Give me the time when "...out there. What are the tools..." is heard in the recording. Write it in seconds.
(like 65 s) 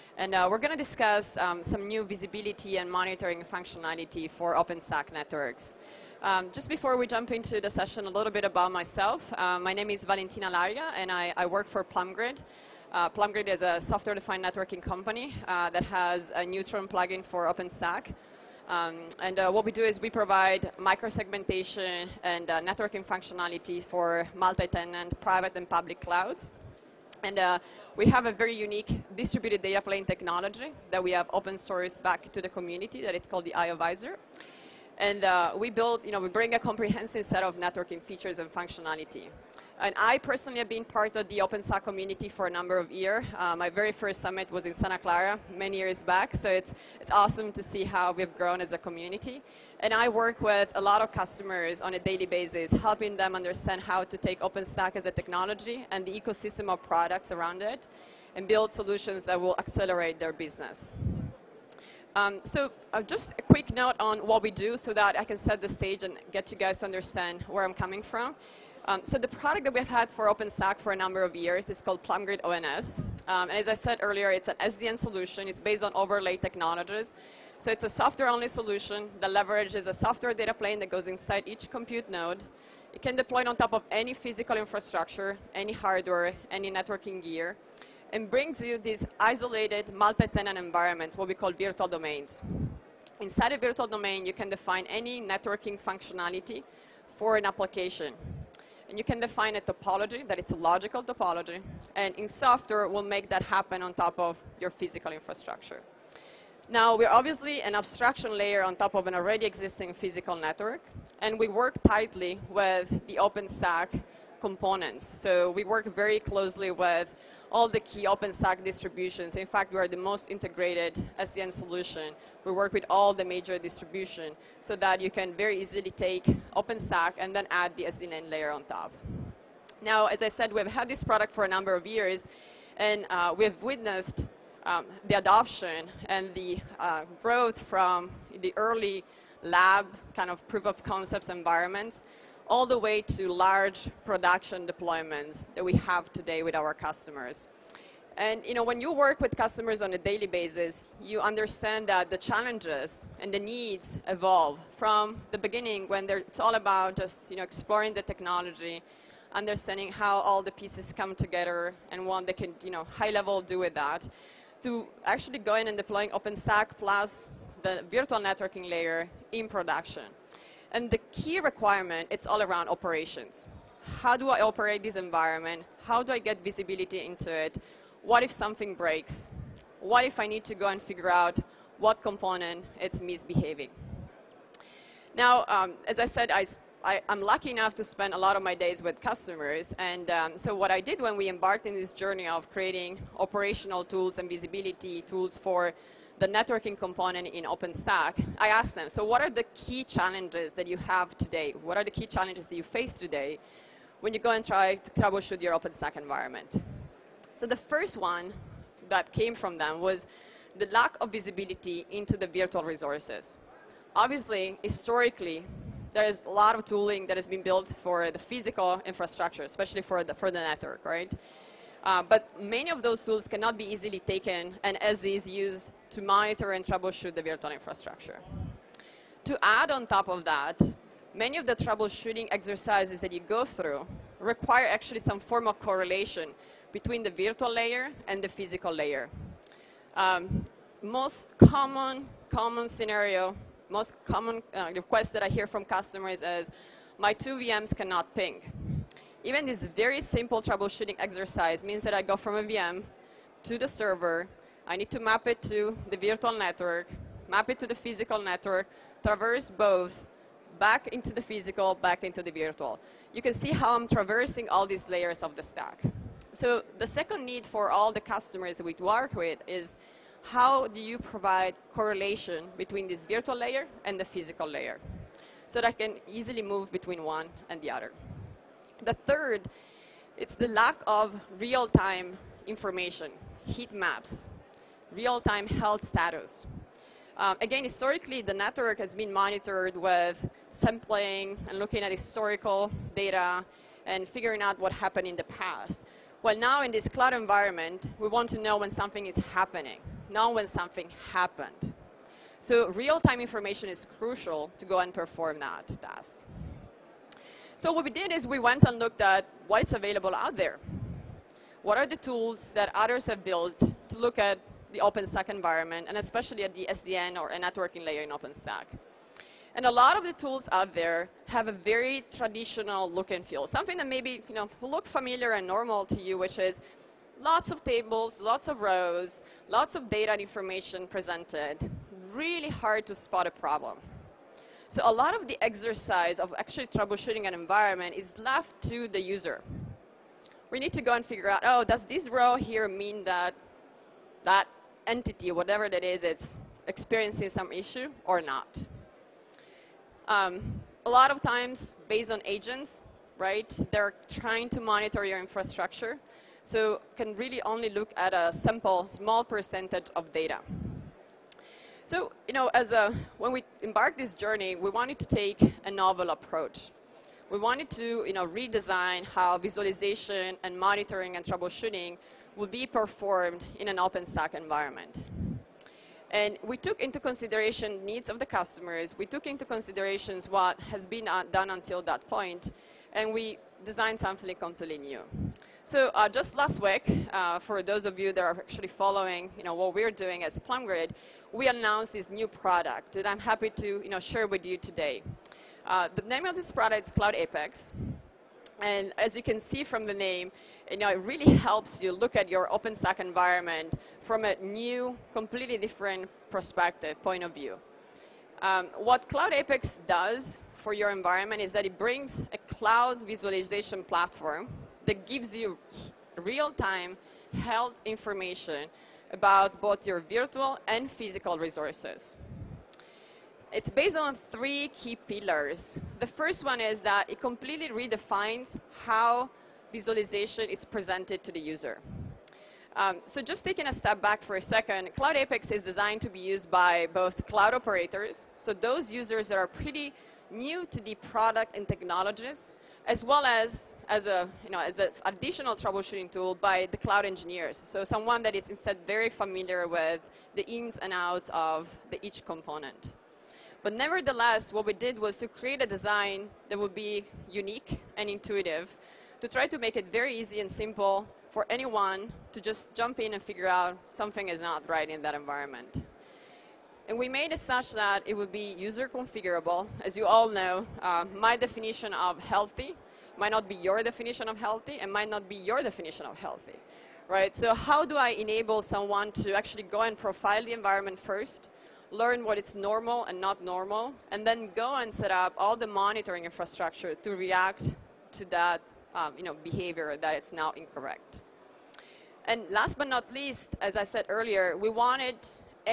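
310 s.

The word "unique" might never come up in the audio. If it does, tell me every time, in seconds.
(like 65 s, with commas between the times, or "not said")
28 s, 457 s.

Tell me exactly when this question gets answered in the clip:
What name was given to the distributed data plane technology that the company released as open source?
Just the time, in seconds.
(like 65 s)
33 s.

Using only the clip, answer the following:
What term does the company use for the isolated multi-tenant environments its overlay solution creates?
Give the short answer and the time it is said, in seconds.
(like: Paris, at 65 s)
virtual domains, at 91 s.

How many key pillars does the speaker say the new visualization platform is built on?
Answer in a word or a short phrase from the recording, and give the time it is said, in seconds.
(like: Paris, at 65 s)
3, at 424 s.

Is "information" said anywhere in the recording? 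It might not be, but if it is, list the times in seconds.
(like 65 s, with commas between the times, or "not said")
282 s, 303 s, 330 s, 417 s.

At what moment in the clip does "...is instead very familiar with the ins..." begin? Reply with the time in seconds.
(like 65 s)
448 s.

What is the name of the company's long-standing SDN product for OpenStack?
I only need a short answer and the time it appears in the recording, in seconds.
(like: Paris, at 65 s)
PlumGrid ONS, at 72 s.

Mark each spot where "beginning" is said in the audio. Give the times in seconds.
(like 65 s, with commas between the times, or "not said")
155 s.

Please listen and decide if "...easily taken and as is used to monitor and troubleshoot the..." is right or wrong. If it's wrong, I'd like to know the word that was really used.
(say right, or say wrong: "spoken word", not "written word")
right.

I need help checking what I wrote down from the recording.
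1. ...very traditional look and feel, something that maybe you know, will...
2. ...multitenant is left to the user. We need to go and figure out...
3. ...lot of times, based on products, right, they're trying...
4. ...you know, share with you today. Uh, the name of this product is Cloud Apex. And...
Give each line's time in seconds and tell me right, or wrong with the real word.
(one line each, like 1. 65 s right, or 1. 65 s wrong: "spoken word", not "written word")
1. 321 s right
2. 337 s wrong: "environment", not "multitenant"
3. 350 s wrong: "agents", not "products"
4. 393 s right.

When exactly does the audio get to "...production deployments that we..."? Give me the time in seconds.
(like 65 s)
144 s.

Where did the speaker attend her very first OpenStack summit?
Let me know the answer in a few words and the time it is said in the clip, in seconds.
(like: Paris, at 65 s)
Santa Clara, at 44 s.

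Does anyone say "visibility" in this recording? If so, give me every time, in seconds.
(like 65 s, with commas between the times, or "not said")
2 s, 176 s, 194 s, 211 s.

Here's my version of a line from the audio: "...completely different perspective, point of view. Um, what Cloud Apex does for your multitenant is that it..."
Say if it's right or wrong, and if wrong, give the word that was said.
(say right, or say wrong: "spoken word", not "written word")
wrong: "environment", not "multitenant".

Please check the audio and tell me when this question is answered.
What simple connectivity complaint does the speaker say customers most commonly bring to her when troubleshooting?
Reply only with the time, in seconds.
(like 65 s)
246 s.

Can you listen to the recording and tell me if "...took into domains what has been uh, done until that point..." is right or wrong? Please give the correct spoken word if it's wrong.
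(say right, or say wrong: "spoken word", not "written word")
wrong: "considerations", not "domains".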